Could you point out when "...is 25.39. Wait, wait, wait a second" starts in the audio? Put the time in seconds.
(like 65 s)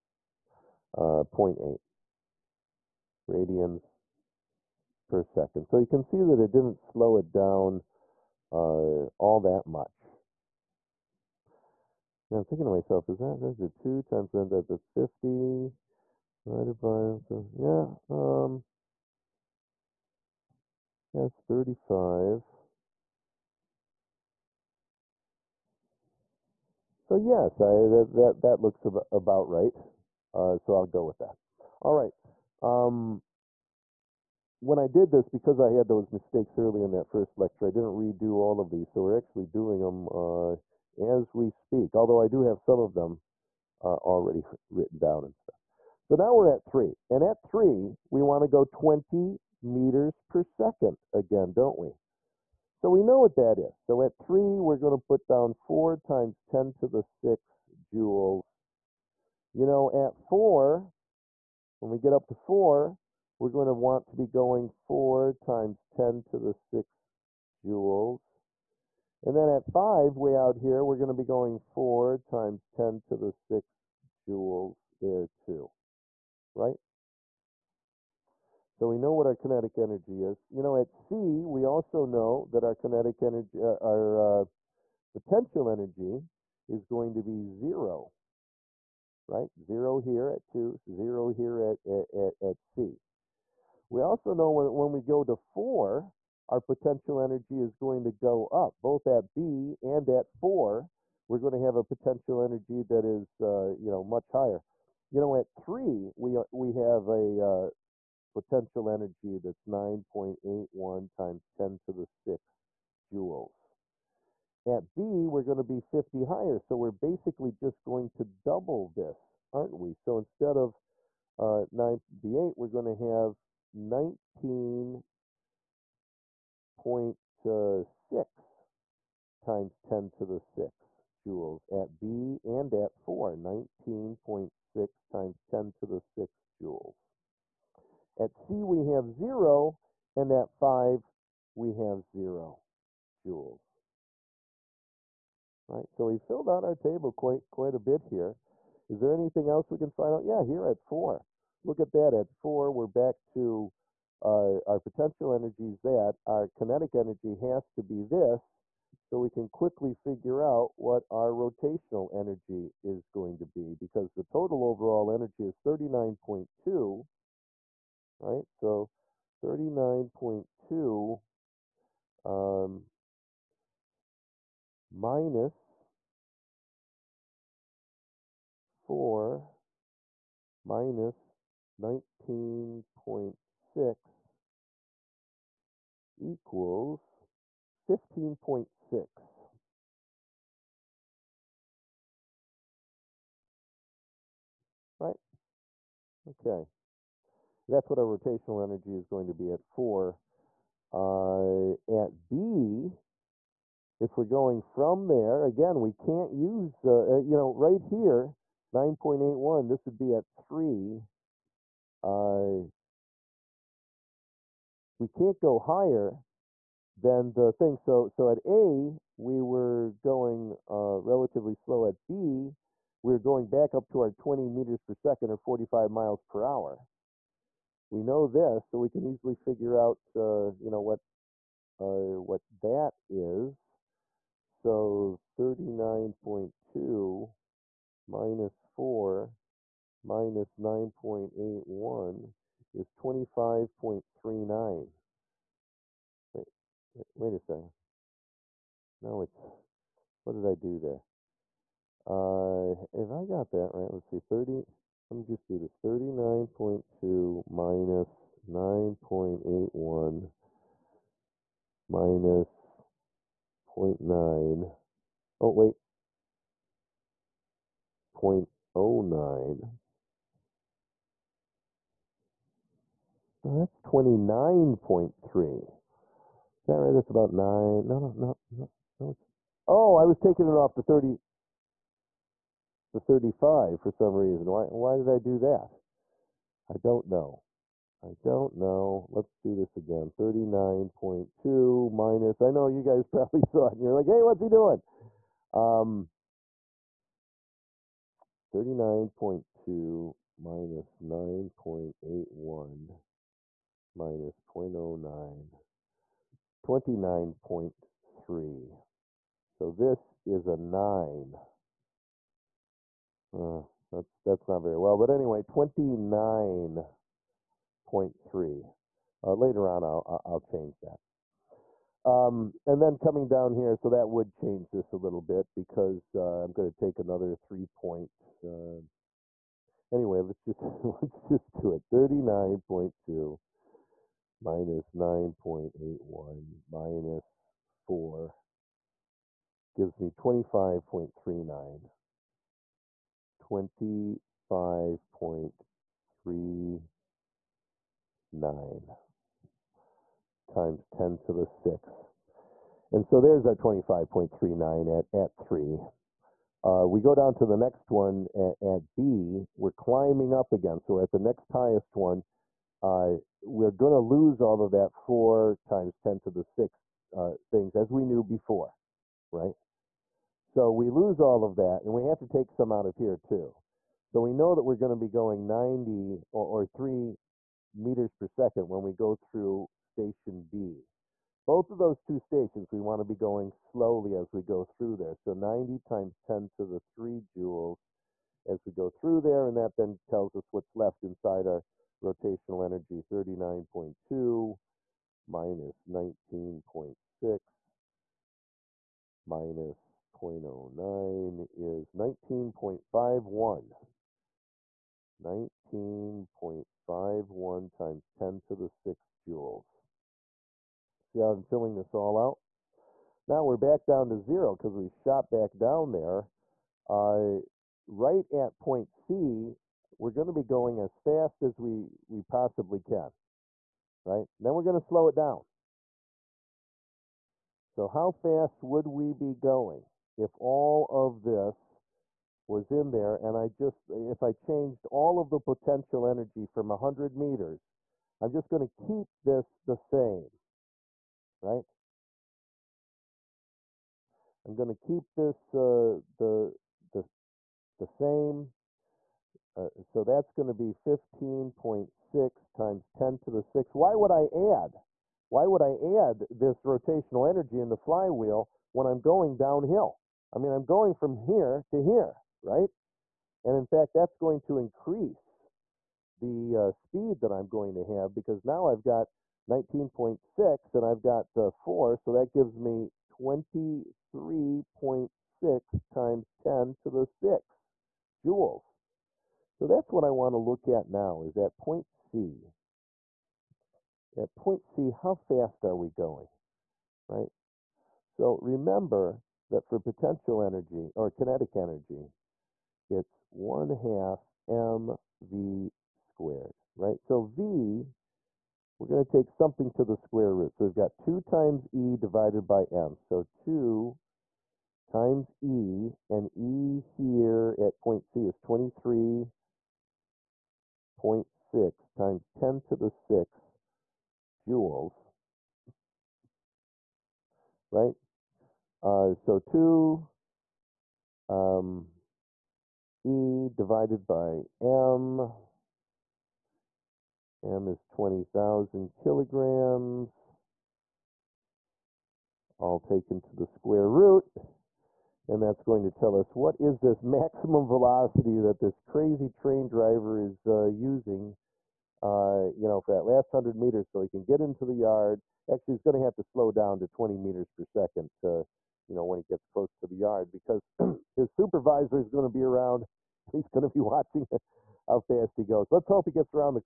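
242 s.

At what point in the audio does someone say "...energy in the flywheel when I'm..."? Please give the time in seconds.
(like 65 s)
457 s.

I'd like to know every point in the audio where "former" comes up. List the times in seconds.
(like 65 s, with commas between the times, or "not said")
not said.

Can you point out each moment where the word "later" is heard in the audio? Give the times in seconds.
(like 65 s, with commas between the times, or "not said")
319 s.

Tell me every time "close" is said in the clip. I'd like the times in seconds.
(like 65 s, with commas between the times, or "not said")
549 s.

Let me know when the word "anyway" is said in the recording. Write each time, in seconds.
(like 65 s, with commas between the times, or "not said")
315 s, 329 s.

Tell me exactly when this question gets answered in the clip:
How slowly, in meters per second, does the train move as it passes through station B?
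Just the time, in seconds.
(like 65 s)
376 s.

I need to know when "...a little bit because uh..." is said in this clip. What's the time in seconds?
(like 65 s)
324 s.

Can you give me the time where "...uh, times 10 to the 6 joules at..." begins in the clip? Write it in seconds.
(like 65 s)
127 s.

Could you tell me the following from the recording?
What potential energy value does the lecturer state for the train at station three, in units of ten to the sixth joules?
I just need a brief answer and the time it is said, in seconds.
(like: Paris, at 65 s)
9.81, at 109 s.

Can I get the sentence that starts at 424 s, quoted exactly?
then we're going to slow it down.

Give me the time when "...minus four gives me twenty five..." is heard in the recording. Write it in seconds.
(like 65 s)
336 s.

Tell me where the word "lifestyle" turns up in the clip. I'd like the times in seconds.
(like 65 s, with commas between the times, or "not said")
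not said.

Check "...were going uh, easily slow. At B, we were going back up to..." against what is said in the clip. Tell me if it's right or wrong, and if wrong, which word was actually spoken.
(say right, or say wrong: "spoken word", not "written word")
wrong: "relatively", not "easily".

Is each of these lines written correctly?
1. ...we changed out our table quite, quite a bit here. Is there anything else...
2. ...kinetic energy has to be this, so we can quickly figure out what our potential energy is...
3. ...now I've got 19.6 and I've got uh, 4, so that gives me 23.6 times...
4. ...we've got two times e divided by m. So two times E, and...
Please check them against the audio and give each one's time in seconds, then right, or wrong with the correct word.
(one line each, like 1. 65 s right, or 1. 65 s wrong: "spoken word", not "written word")
1. 146 s wrong: "filled", not "changed"
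2. 156 s wrong: "rotational", not "potential"
3. 468 s right
4. 500 s right.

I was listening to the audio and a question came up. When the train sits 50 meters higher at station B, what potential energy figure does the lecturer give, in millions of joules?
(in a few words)
19.6.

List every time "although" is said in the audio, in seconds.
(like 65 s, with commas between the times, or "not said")
41 s.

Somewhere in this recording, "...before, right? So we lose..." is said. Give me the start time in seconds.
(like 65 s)
368 s.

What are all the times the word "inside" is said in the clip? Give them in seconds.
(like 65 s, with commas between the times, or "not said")
391 s.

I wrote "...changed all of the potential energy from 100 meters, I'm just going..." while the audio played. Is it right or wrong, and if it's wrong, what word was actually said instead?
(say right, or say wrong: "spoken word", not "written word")
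right.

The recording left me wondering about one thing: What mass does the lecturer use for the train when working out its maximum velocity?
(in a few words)
20,000 kilograms.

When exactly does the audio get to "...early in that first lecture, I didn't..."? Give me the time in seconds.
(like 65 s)
36 s.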